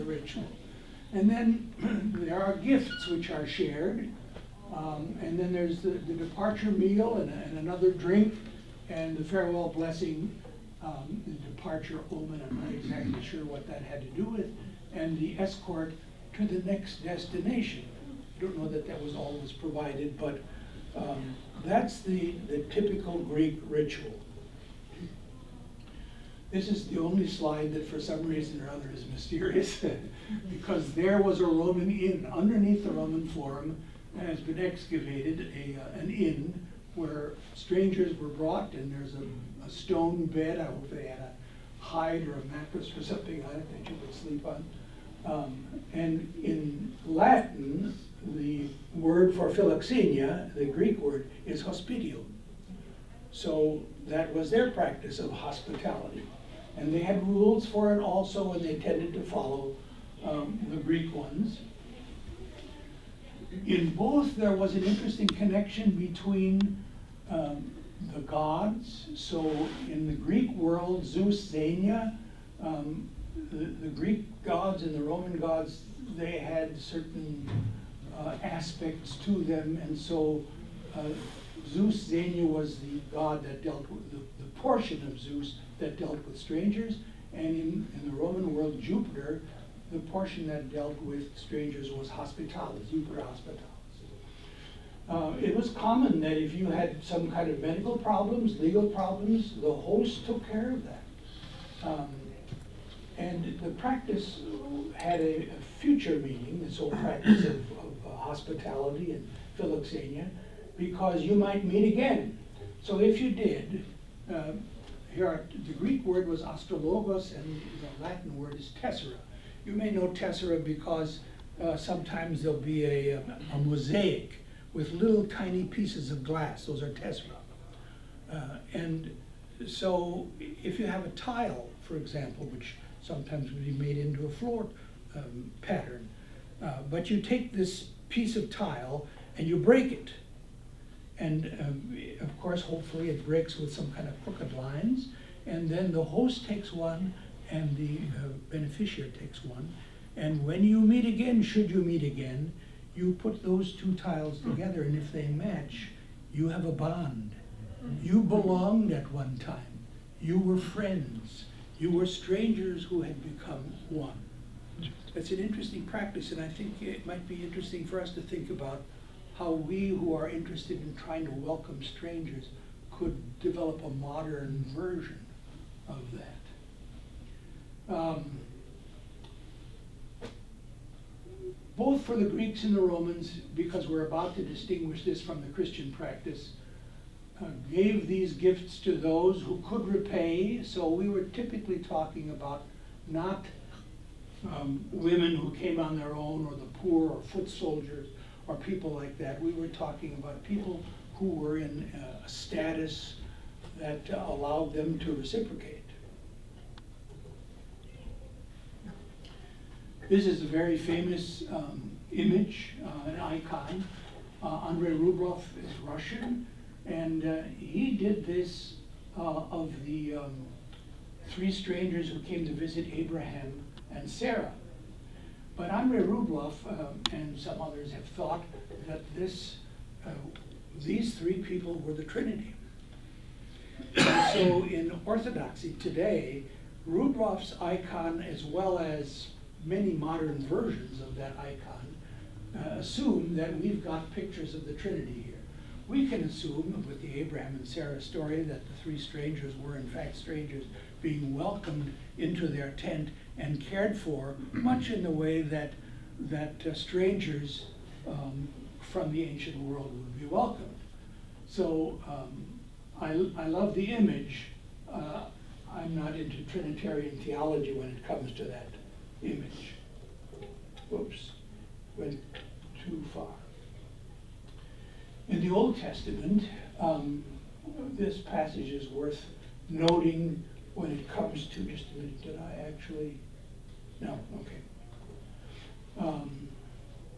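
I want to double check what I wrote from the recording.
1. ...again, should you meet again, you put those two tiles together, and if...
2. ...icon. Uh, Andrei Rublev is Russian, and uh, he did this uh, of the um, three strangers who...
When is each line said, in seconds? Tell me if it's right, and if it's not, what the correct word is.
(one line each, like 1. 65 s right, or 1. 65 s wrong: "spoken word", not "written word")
1. 151 s right
2. 213 s right.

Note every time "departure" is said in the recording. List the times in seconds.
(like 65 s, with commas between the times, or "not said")
6 s, 11 s.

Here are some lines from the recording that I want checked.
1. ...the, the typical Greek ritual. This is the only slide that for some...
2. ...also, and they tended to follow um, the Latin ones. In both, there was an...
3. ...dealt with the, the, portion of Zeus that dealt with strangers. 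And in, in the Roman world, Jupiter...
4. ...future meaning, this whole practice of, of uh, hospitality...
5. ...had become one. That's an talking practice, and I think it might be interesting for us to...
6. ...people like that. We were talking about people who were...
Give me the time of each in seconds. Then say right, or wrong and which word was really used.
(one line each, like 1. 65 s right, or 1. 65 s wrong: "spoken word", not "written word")
1. 22 s right
2. 58 s wrong: "Greek", not "Latin"
3. 83 s right
4. 105 s right
5. 163 s wrong: "interesting", not "talking"
6. 198 s right.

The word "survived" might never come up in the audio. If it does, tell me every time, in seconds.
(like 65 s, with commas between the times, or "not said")
not said.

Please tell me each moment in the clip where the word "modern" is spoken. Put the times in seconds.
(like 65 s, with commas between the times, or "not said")
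173 s, 239 s.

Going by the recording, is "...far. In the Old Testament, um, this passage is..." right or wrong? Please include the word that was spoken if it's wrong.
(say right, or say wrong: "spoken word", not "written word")
right.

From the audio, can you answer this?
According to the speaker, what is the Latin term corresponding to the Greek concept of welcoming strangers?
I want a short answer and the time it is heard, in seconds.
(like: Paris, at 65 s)
hospitio, at 51 s.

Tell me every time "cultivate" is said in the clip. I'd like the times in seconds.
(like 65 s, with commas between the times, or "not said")
not said.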